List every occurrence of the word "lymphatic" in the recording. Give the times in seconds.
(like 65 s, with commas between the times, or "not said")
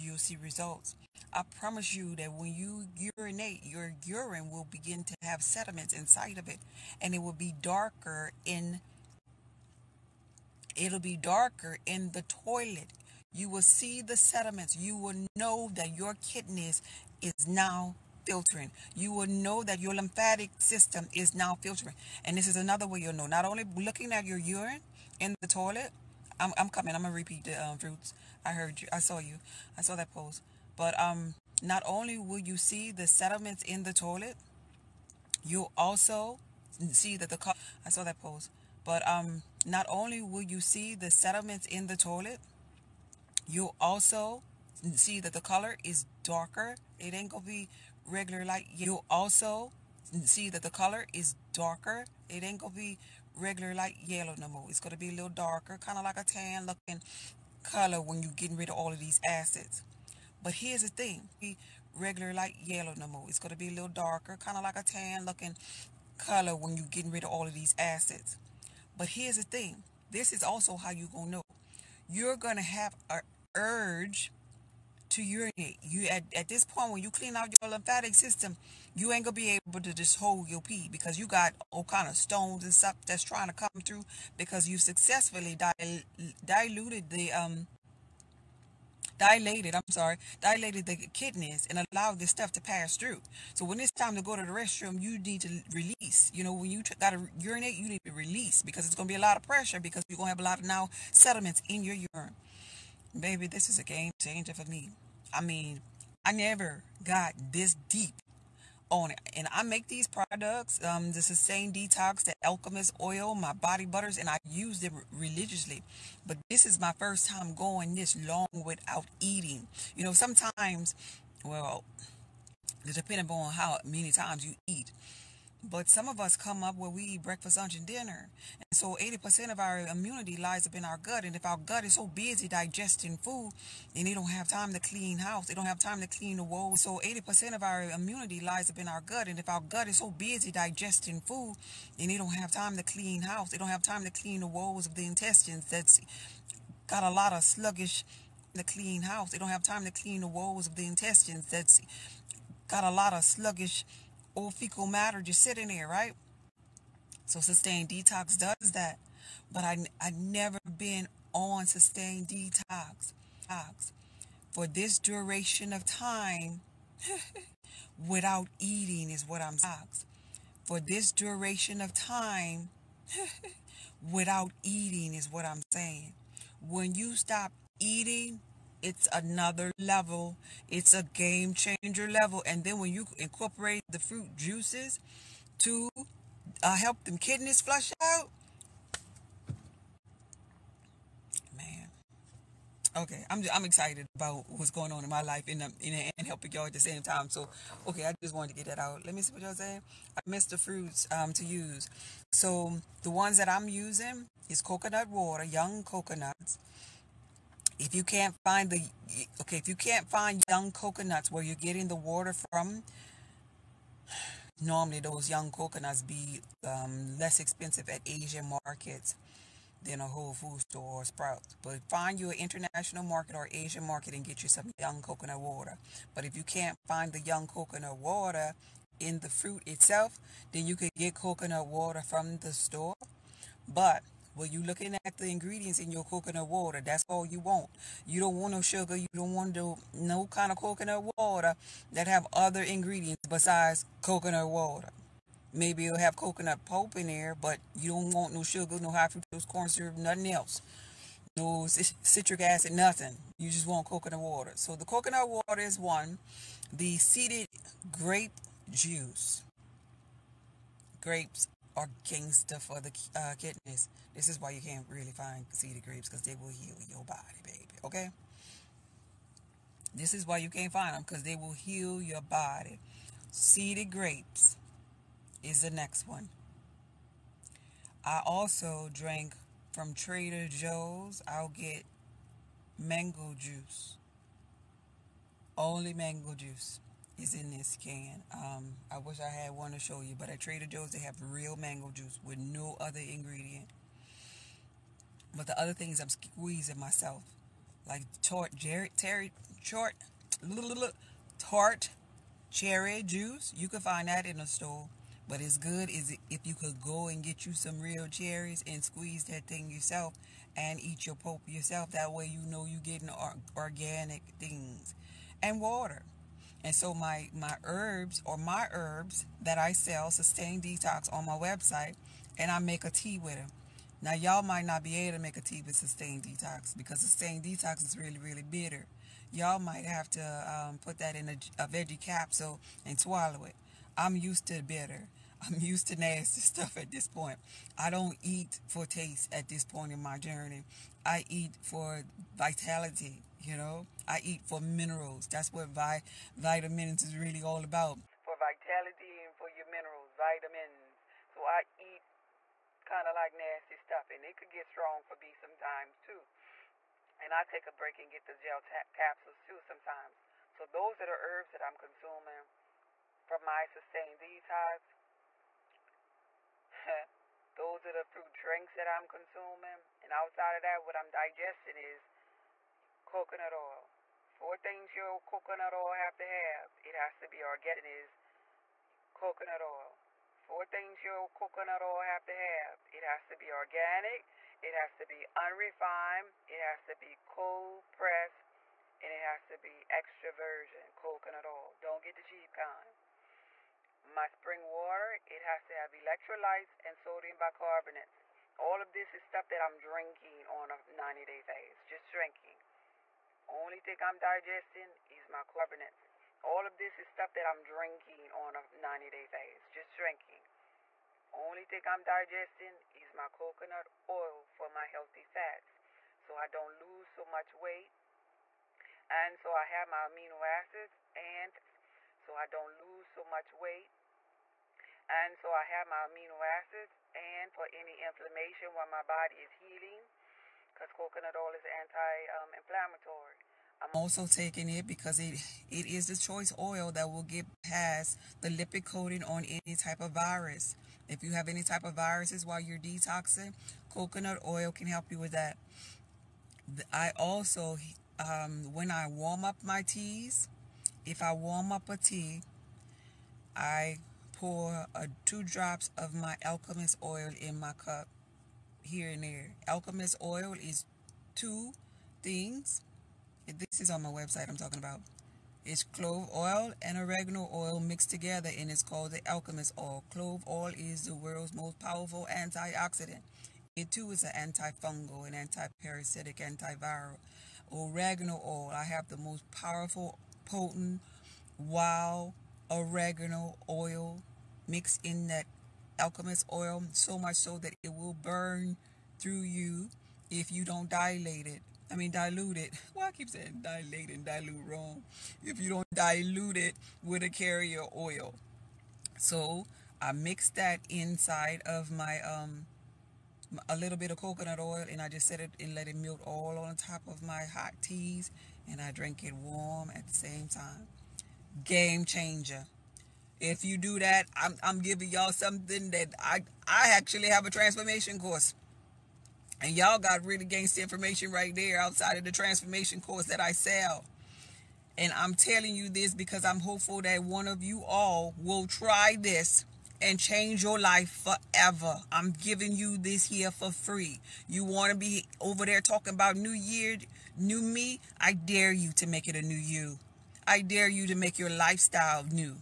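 19 s, 77 s.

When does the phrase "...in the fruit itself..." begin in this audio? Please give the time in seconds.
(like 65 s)
228 s.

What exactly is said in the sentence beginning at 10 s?
It'll be darker in the toilet.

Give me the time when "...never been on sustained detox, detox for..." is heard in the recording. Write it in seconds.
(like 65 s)
160 s.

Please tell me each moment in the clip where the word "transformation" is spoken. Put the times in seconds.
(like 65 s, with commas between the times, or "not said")
517 s, 522 s.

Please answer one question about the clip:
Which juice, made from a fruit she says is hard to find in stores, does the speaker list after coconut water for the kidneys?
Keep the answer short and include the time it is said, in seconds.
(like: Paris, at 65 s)
seeded grape juice, at 256 s.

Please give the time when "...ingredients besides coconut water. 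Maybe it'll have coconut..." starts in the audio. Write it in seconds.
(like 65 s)
242 s.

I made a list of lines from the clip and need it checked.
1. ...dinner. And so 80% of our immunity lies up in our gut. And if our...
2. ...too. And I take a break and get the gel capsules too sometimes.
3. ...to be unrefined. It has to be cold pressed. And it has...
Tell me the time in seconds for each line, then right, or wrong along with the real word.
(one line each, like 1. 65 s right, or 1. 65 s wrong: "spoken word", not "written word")
1. 127 s right
2. 355 s right
3. 384 s right.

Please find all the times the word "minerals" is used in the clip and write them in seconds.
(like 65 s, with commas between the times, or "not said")
344 s, 349 s.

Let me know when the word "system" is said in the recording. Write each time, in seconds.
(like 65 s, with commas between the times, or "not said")
20 s, 78 s.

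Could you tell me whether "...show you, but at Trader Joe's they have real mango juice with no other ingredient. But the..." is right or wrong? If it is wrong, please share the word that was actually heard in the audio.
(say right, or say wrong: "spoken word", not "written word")
right.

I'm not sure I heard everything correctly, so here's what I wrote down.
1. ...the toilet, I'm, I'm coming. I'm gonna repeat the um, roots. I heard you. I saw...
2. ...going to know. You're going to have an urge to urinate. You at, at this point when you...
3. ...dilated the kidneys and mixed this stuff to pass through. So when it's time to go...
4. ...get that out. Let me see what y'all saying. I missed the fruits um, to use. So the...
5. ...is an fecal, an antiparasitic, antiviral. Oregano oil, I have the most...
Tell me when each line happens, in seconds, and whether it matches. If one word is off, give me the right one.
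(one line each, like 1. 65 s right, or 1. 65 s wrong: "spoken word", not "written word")
1. 25 s right
2. 71 s right
3. 90 s wrong: "allowed", not "mixed"
4. 198 s right
5. 474 s wrong: "antifungal", not "fecal".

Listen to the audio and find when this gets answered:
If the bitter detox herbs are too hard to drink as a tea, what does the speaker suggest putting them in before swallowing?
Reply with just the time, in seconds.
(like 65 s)
331 s.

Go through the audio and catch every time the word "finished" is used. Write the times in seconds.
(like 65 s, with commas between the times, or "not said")
not said.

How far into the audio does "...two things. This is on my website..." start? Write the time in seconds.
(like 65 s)
461 s.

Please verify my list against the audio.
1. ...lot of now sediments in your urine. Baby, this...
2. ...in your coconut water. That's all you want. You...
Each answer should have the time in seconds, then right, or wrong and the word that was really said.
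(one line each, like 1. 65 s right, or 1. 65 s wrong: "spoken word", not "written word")
1. 100 s right
2. 235 s right.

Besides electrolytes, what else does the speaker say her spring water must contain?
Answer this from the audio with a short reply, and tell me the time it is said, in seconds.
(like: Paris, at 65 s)
sodium bicarbonate, at 396 s.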